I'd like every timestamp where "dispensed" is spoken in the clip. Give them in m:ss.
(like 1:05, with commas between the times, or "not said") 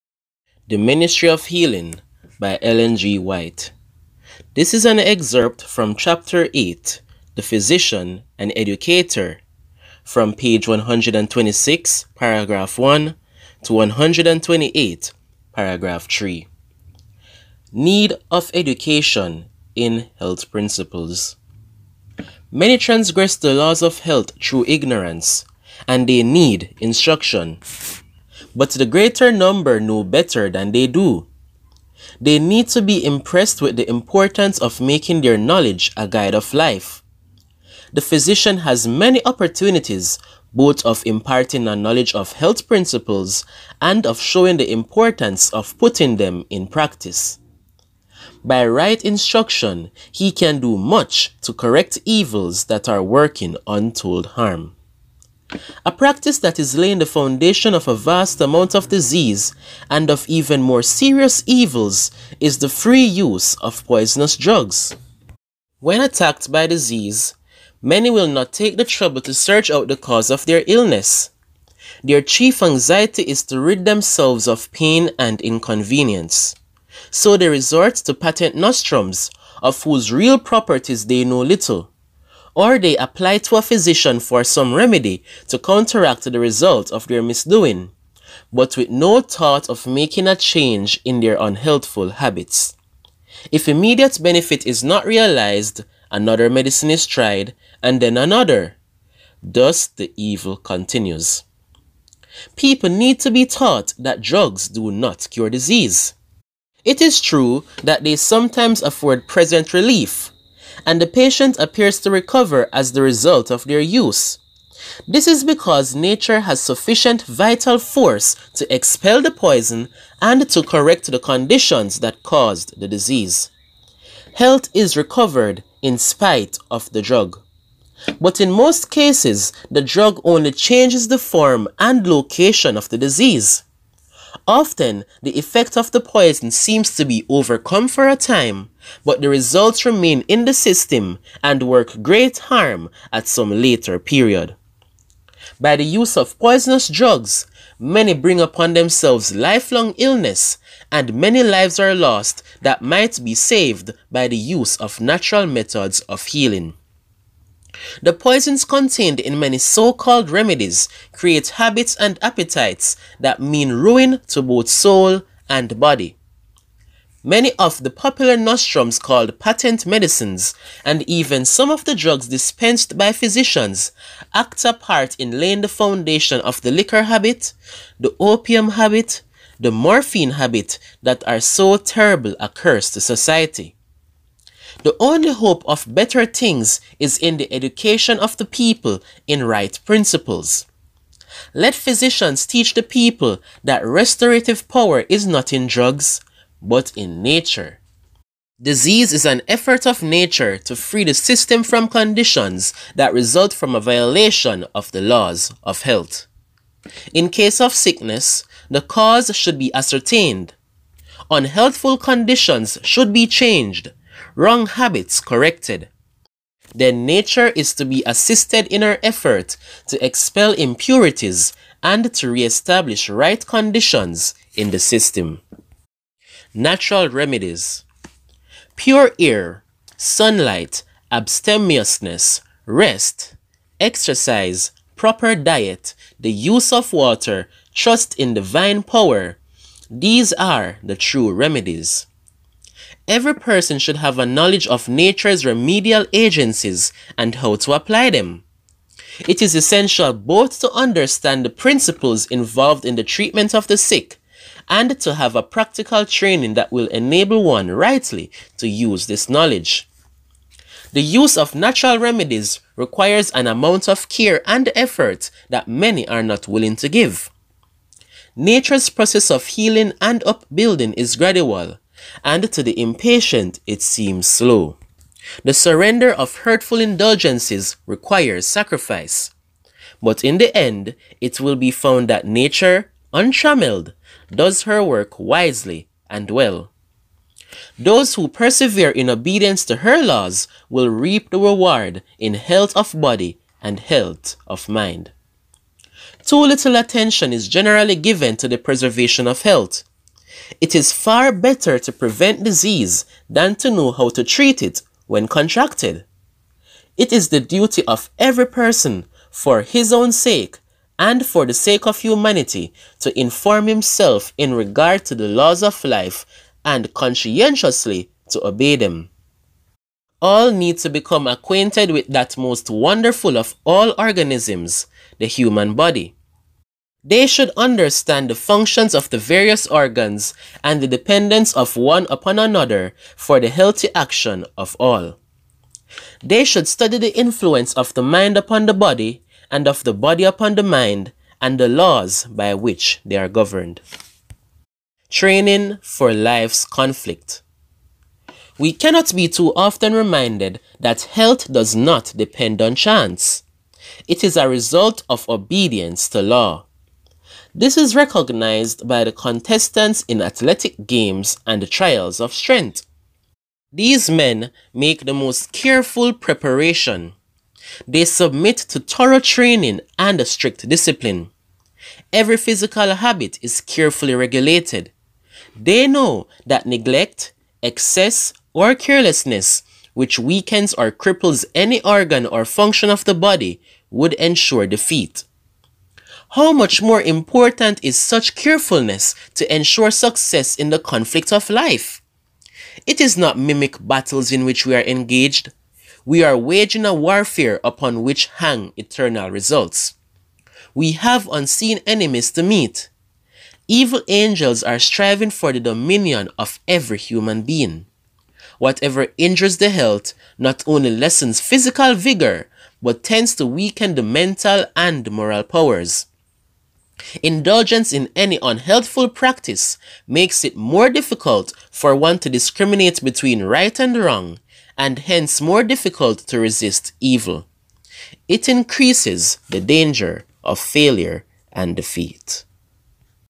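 2:52.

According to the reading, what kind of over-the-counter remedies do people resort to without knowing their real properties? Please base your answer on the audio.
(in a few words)
patent nostrums.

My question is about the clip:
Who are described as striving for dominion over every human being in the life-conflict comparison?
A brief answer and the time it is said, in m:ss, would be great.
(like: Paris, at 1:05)
Evil angels, at 6:43.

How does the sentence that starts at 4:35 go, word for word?
The surrender of hurtful indulgences requires sacrifice.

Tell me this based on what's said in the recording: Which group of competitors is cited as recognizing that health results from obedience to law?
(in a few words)
contestants in athletic games.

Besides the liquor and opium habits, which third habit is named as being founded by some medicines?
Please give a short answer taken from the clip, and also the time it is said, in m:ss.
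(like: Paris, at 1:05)
the morphine habit, at 2:59.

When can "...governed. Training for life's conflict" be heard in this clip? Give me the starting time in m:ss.
5:43.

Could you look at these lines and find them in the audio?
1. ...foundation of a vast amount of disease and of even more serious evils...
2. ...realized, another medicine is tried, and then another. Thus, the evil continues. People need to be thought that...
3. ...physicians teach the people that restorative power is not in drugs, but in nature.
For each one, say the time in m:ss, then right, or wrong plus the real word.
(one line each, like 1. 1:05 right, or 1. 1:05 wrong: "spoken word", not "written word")
1. 0:57 right
2. 1:35 wrong: "taught", not "thought"
3. 3:11 right.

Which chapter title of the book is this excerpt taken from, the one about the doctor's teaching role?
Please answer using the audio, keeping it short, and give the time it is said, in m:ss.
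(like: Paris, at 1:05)
The Physician and Educator, at 0:07.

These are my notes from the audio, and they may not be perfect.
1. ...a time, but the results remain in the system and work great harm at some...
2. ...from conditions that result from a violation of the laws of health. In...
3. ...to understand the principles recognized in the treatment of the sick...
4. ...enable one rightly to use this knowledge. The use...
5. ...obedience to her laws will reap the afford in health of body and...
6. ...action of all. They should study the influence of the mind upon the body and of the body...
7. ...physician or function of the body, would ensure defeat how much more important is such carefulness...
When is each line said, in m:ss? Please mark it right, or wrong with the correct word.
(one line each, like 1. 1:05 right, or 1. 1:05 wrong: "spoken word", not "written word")
1. 2:18 right
2. 3:21 right
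3. 4:10 wrong: "involved", not "recognized"
4. 4:16 right
5. 4:49 wrong: "reward", not "afford"
6. 5:33 right
7. 6:21 wrong: "organ", not "physician".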